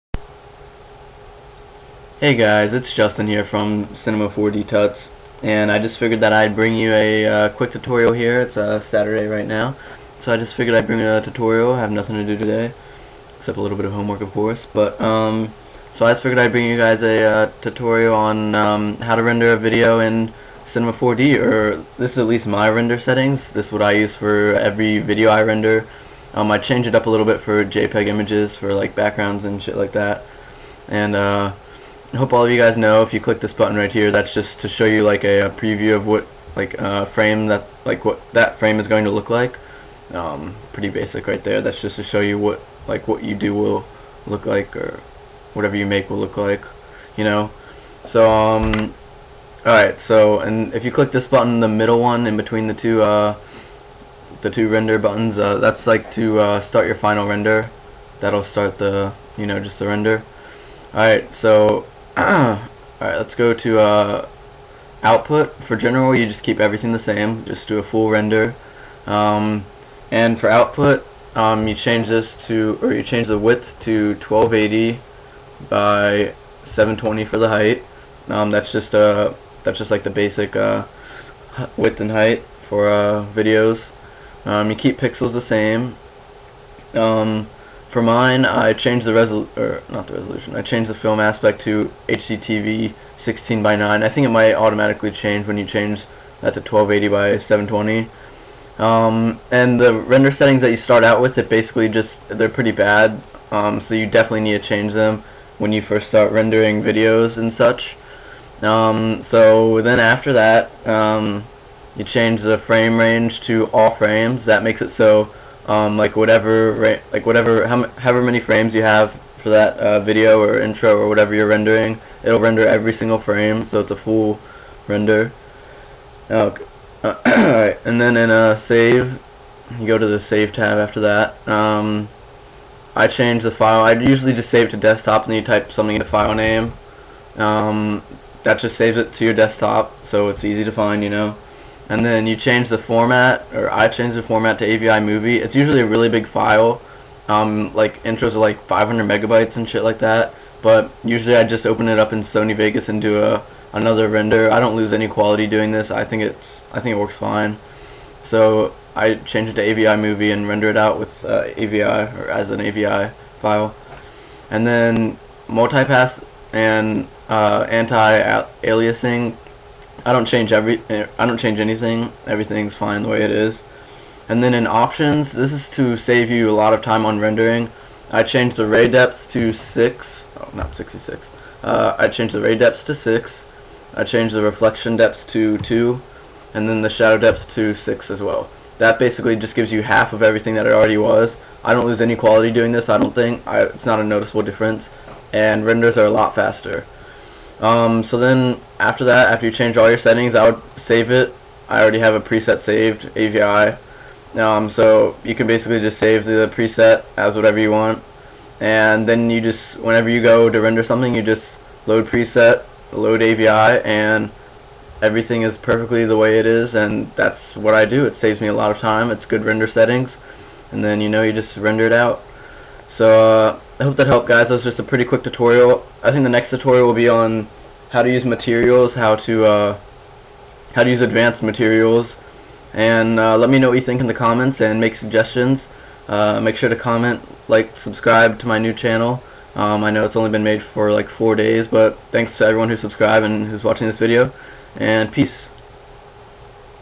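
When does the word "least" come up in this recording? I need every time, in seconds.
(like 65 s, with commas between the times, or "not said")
22 s.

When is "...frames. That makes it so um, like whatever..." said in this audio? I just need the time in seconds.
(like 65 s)
113 s.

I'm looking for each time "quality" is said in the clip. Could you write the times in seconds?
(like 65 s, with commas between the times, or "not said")
155 s, 192 s.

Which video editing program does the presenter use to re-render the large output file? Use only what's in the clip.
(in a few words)
Sony Vegas.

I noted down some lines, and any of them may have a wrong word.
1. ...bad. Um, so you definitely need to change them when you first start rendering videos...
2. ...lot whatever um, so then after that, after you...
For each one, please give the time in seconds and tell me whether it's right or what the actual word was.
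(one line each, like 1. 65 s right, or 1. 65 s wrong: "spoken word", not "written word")
1. 102 s right
2. 196 s wrong: "faster", not "whatever".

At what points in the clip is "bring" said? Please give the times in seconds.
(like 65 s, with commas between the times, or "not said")
6 s, 10 s, 16 s.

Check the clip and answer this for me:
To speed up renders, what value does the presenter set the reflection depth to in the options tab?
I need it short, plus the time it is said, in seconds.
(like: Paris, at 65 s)
2, at 185 s.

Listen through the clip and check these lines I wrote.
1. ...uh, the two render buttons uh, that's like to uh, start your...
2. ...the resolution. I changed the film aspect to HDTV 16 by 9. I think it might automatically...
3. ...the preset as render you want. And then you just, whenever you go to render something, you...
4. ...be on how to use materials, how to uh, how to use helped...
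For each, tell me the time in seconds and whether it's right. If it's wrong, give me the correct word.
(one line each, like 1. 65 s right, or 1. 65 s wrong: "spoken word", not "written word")
1. 53 s right
2. 90 s right
3. 206 s wrong: "whatever", not "render"
4. 226 s wrong: "advanced", not "helped".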